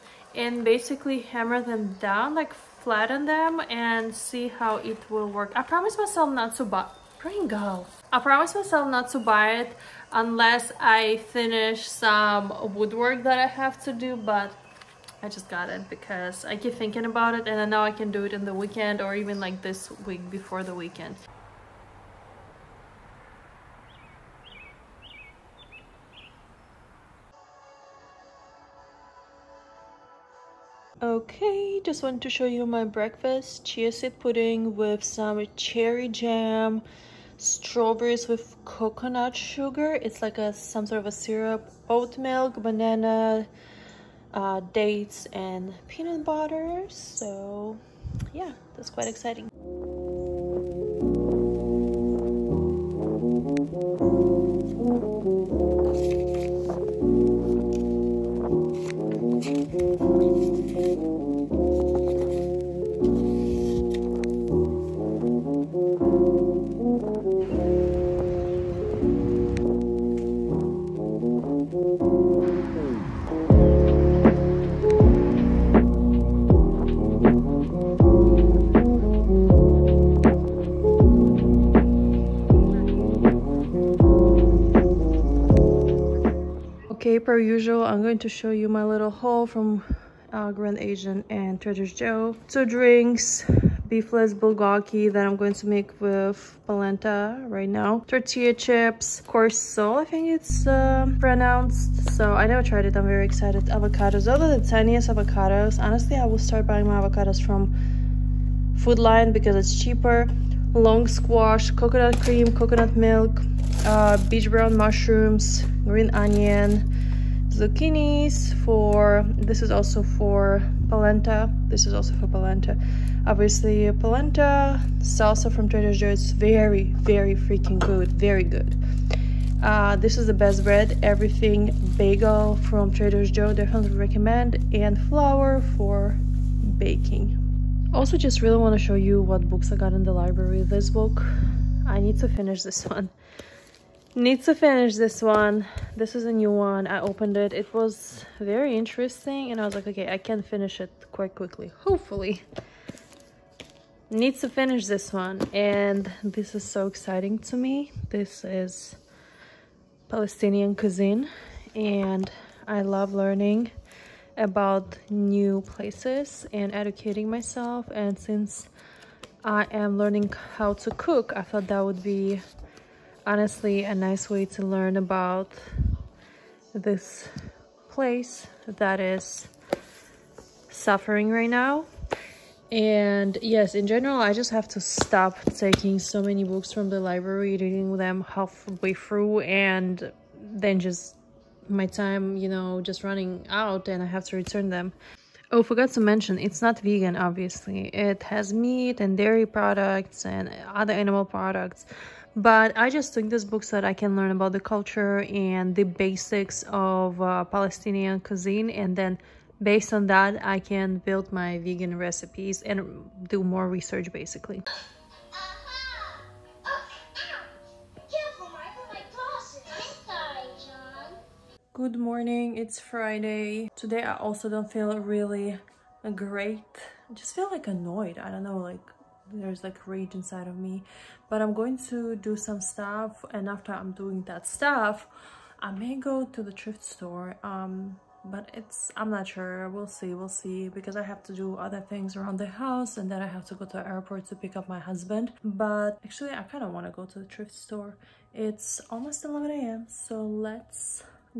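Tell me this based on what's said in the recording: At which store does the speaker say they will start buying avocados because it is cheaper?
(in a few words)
Food Lion.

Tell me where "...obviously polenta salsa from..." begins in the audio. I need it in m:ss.
2:03.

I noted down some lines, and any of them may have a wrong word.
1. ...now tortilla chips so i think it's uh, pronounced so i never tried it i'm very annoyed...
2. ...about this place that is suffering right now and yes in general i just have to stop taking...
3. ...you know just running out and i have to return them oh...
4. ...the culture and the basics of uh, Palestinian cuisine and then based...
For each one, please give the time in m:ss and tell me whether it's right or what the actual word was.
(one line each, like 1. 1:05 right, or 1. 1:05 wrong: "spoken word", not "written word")
1. 1:37 wrong: "excited", not "annoyed"
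2. 2:54 right
3. 3:12 right
4. 3:24 right.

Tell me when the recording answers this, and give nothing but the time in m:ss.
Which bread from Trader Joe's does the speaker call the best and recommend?
2:11.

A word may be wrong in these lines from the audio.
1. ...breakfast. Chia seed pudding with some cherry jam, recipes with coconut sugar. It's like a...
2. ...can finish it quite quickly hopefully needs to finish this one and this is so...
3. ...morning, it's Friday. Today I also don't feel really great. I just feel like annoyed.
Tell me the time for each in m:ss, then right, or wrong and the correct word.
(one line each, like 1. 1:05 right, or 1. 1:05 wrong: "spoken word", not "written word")
1. 0:32 wrong: "strawberries", not "recipes"
2. 2:30 right
3. 3:41 right.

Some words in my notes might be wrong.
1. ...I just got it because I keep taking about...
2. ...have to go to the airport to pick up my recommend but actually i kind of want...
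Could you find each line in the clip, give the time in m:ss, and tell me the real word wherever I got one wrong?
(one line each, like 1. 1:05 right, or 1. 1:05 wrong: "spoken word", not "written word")
1. 0:15 wrong: "thinking", not "taking"
2. 4:03 wrong: "husband", not "recommend".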